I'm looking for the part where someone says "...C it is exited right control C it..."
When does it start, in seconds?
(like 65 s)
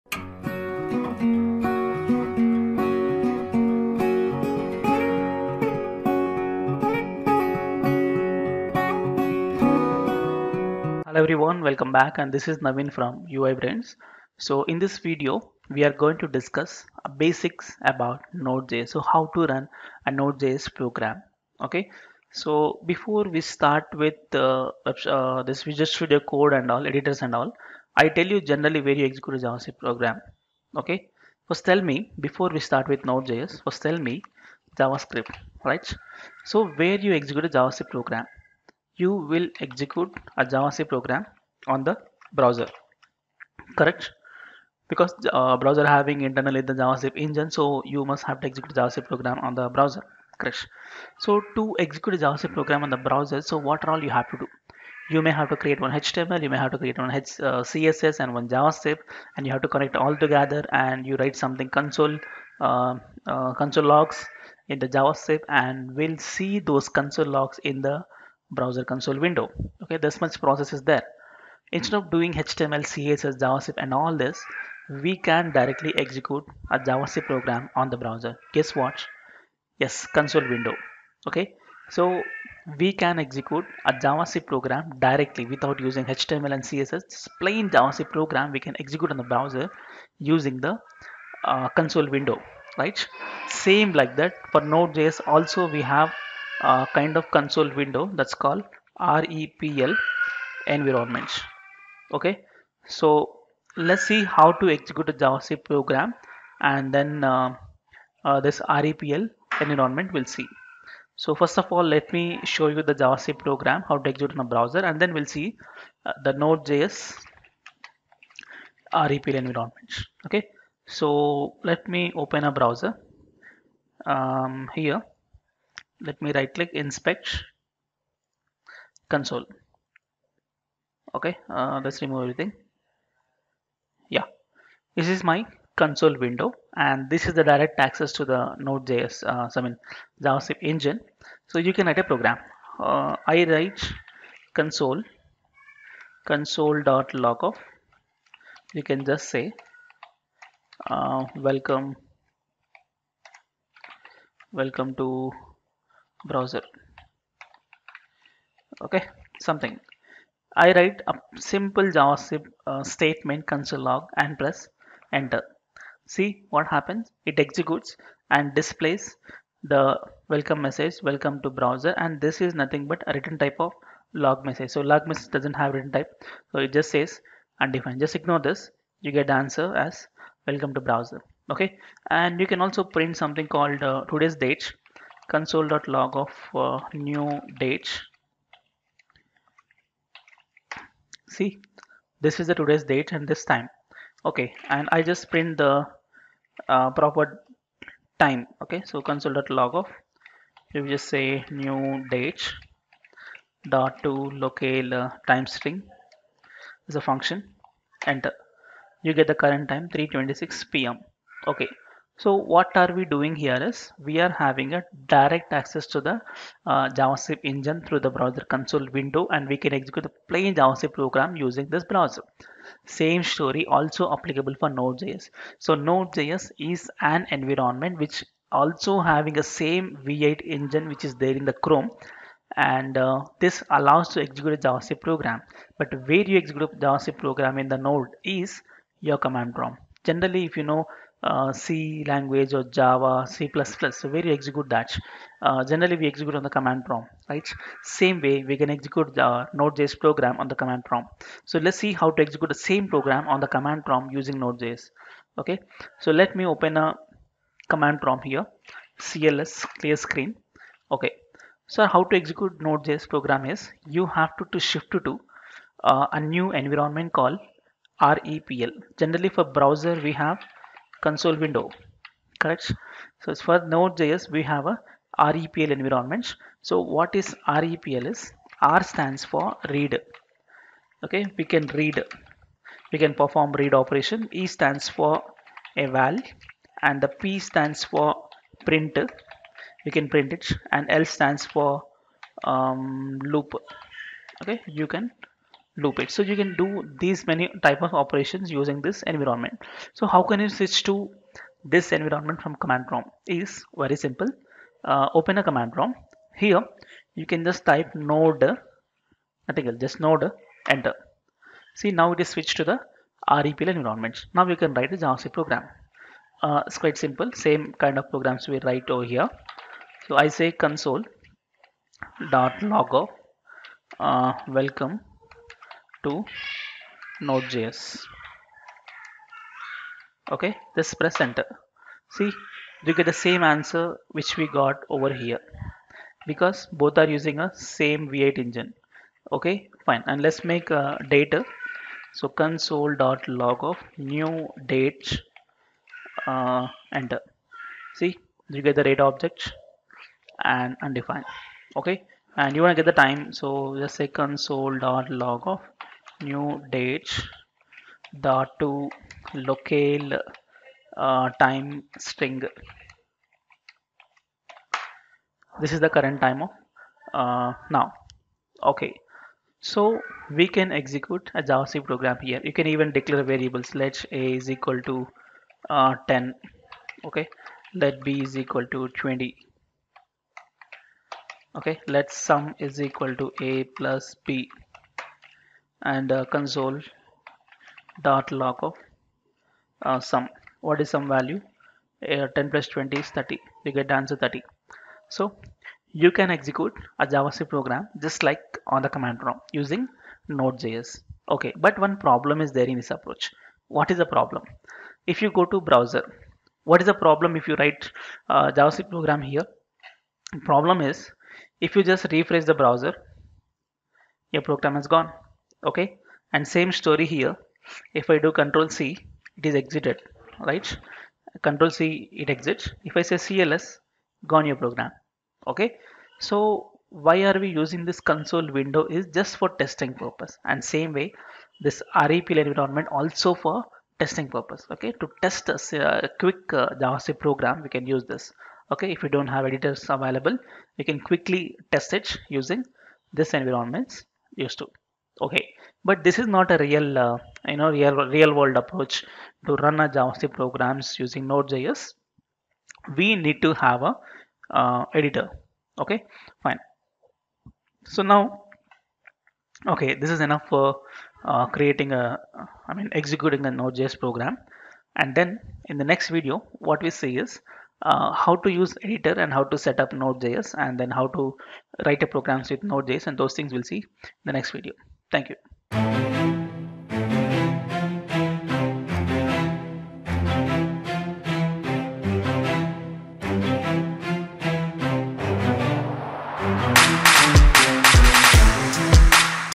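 418 s.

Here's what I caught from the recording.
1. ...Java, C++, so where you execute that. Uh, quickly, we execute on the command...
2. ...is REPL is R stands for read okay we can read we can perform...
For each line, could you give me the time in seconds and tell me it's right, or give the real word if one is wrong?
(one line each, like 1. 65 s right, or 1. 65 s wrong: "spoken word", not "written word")
1. 242 s wrong: "generally", not "quickly"
2. 277 s right.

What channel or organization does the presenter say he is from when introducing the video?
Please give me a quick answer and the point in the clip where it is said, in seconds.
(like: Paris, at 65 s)
UI Brains, at 13 s.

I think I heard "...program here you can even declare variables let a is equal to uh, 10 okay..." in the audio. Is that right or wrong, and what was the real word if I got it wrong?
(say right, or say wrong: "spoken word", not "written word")
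right.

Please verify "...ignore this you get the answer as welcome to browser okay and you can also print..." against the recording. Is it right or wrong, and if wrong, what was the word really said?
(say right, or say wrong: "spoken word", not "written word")
right.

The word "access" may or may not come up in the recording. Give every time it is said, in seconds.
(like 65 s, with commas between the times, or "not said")
137 s, 215 s.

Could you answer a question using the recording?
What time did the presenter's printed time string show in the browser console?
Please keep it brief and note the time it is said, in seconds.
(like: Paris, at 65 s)
3:26 p.m., at 209 s.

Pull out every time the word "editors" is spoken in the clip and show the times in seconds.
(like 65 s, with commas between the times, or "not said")
26 s, 439 s, 455 s, 468 s.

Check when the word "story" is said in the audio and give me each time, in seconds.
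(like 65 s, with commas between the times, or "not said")
223 s, 416 s.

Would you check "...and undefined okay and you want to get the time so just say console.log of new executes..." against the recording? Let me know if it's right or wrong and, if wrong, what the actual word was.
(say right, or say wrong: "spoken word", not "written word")
wrong: "dates", not "executes".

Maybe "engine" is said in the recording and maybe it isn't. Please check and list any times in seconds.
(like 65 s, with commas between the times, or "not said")
47 s, 140 s, 217 s, 230 s, 338 s.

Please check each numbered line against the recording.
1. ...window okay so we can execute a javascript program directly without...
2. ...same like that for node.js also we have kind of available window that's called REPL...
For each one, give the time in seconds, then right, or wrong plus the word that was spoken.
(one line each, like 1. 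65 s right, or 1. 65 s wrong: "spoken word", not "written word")
1. 80 s right
2. 93 s wrong: "console", not "available".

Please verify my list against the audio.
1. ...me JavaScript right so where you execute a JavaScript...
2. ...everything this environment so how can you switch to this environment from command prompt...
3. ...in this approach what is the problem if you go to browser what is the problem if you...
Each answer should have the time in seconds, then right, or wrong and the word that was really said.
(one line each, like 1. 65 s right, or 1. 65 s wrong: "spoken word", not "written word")
1. 33 s right
2. 298 s wrong: "using", not "everything"
3. 402 s right.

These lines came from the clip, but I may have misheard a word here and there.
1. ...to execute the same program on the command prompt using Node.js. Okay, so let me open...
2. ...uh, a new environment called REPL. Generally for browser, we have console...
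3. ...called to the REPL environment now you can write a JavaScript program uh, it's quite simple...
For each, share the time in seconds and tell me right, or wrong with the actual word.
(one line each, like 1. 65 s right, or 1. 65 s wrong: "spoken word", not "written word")
1. 252 s right
2. 265 s right
3. 312 s wrong: "switched", not "called".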